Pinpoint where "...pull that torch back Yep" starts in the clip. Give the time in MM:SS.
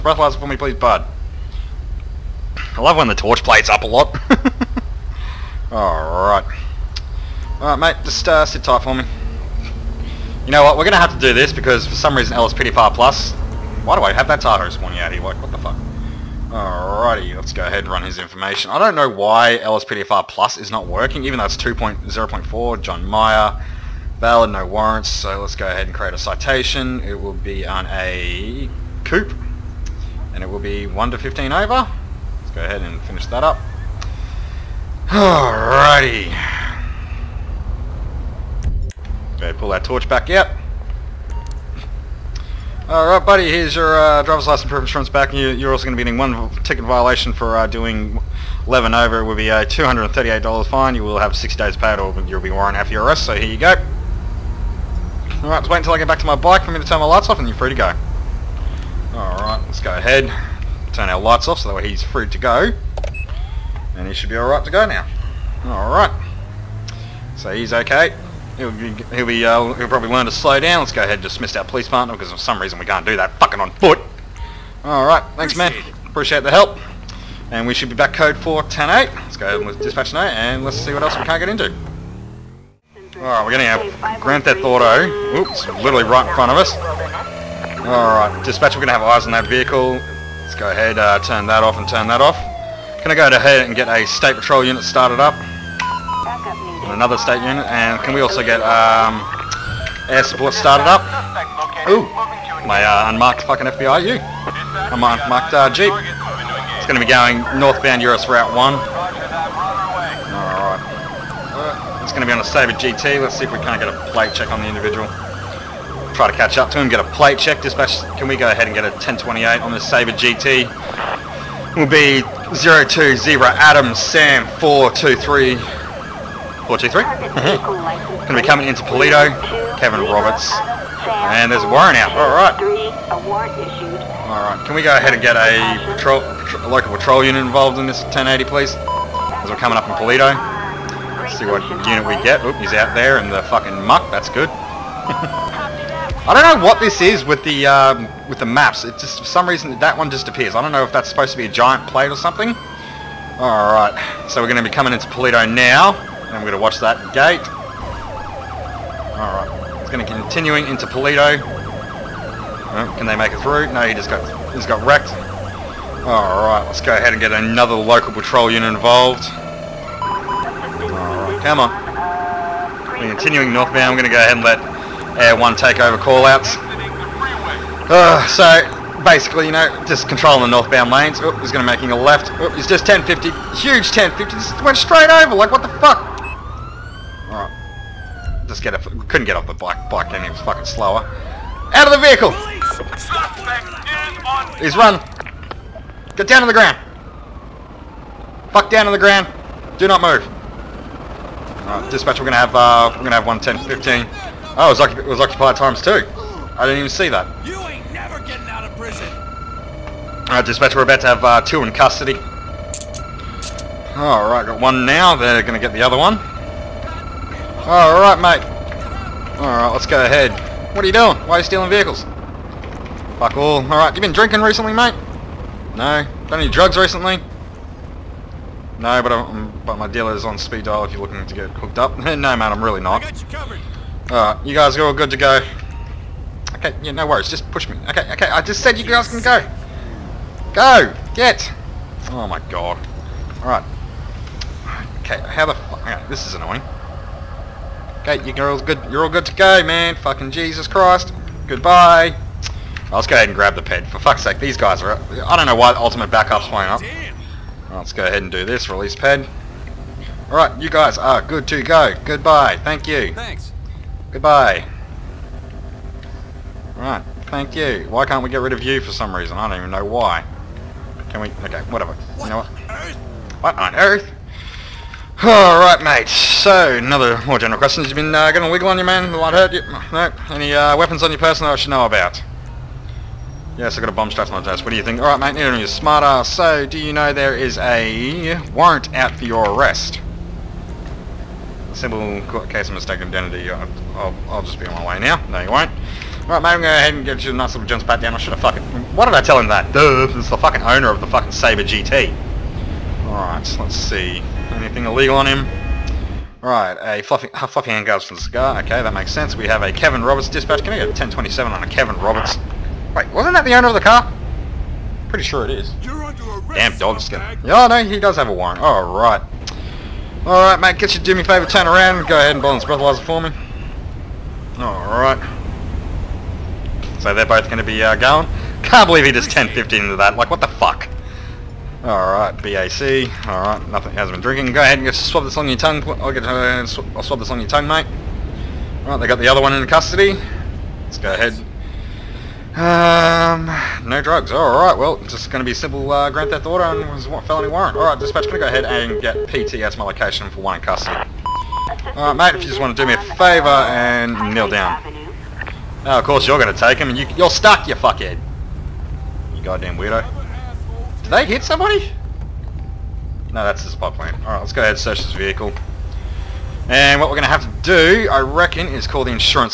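00:39.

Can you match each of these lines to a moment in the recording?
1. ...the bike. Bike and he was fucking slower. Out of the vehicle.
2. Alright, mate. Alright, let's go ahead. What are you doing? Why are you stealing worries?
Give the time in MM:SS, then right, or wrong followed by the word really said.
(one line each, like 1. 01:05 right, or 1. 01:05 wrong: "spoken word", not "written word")
1. 03:09 right
2. 03:37 wrong: "vehicles", not "worries".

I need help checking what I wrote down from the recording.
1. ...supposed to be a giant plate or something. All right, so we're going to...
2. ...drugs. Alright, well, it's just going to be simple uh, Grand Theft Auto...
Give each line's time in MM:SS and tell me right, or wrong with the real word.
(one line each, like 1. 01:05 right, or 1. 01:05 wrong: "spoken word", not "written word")
1. 02:31 right
2. 05:43 right.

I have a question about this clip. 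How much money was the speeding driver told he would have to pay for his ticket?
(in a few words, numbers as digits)
$238.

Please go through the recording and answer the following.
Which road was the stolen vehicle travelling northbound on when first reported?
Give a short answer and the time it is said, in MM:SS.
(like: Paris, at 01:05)
US Route 1, at 01:48.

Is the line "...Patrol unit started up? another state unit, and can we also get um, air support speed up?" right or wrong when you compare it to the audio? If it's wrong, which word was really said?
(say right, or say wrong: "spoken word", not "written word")
wrong: "started", not "speed".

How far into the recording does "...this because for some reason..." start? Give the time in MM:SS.
00:11.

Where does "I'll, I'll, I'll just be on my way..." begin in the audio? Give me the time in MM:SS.
04:53.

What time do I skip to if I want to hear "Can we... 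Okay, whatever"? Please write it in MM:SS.
04:31.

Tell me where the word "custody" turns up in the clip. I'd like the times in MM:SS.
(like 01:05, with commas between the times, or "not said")
03:31, 05:39, 05:50.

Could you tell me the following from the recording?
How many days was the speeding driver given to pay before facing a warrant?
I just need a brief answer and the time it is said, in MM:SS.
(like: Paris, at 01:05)
60, at 00:51.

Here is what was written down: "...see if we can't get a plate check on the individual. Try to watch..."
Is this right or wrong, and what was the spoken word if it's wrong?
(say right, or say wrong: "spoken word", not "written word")
wrong: "catch", not "watch".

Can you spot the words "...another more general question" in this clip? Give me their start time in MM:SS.
04:36.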